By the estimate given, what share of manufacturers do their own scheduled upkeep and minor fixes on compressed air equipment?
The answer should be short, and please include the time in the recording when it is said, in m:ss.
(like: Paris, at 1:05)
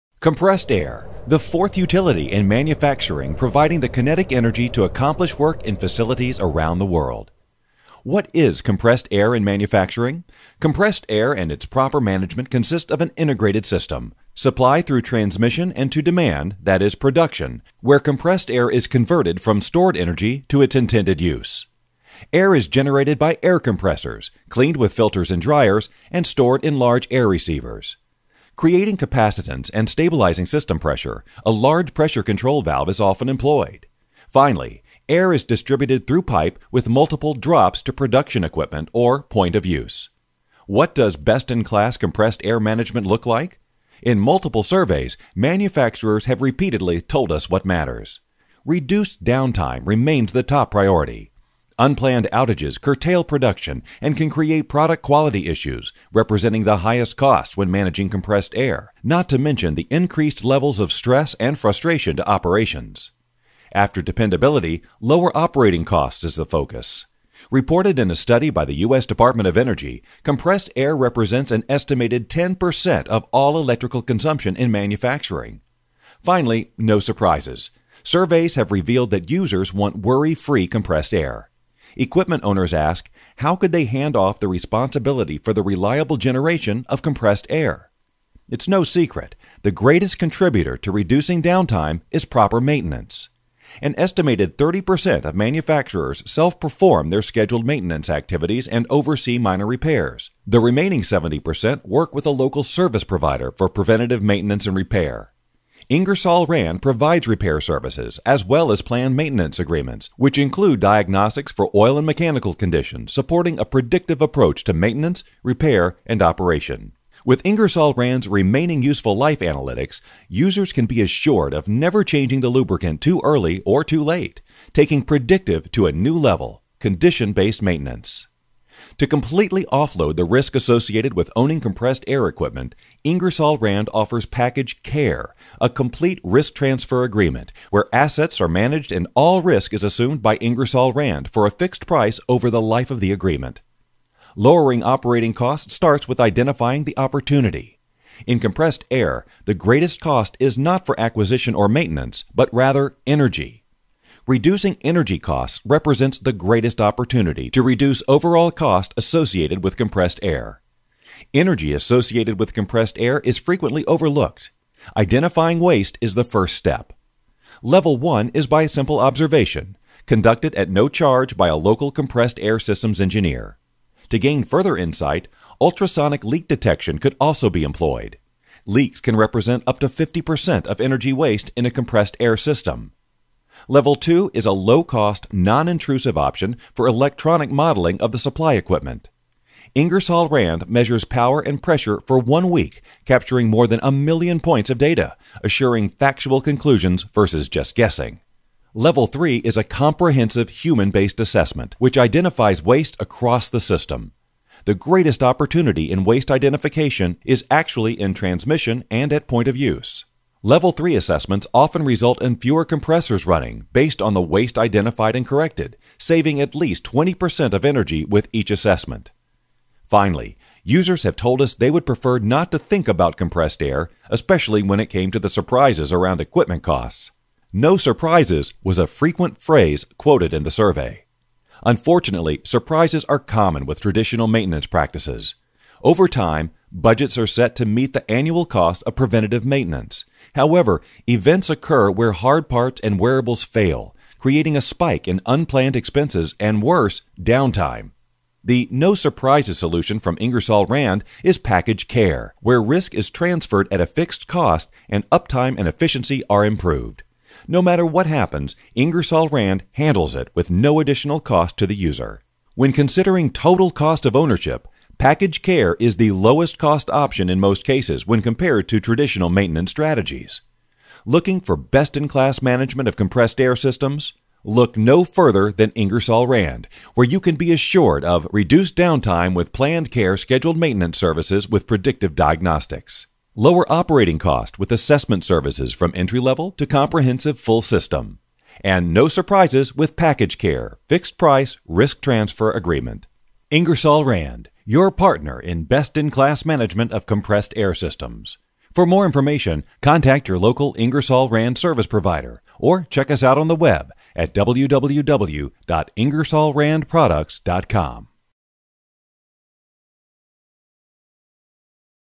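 30%, at 1:34.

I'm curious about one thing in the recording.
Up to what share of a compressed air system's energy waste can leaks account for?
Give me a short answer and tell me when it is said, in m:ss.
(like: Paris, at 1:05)
50%, at 2:59.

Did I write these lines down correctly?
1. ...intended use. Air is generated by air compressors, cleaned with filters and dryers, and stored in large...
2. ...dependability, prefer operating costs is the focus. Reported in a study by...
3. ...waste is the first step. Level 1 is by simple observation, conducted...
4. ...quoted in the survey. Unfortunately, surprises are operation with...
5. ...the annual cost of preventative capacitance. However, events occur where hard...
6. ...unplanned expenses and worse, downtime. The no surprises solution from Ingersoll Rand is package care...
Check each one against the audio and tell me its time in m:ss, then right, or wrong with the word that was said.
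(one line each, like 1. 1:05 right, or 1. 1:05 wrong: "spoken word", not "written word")
1. 0:20 right
2. 1:04 wrong: "lower", not "prefer"
3. 2:45 right
4. 3:49 wrong: "common", not "operation"
5. 3:57 wrong: "maintenance", not "capacitance"
6. 4:05 right.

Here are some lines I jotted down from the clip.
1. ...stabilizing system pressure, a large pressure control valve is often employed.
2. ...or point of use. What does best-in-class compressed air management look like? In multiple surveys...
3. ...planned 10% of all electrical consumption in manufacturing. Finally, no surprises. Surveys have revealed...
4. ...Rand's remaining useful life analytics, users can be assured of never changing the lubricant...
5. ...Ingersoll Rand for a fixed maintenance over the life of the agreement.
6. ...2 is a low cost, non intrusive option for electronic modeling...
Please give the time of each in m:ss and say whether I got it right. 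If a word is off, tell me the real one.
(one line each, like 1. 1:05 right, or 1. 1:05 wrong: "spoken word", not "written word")
1. 0:29 right
2. 0:38 right
3. 1:11 wrong: "estimated", not "planned"
4. 1:57 right
5. 2:20 wrong: "price", not "maintenance"
6. 3:03 right.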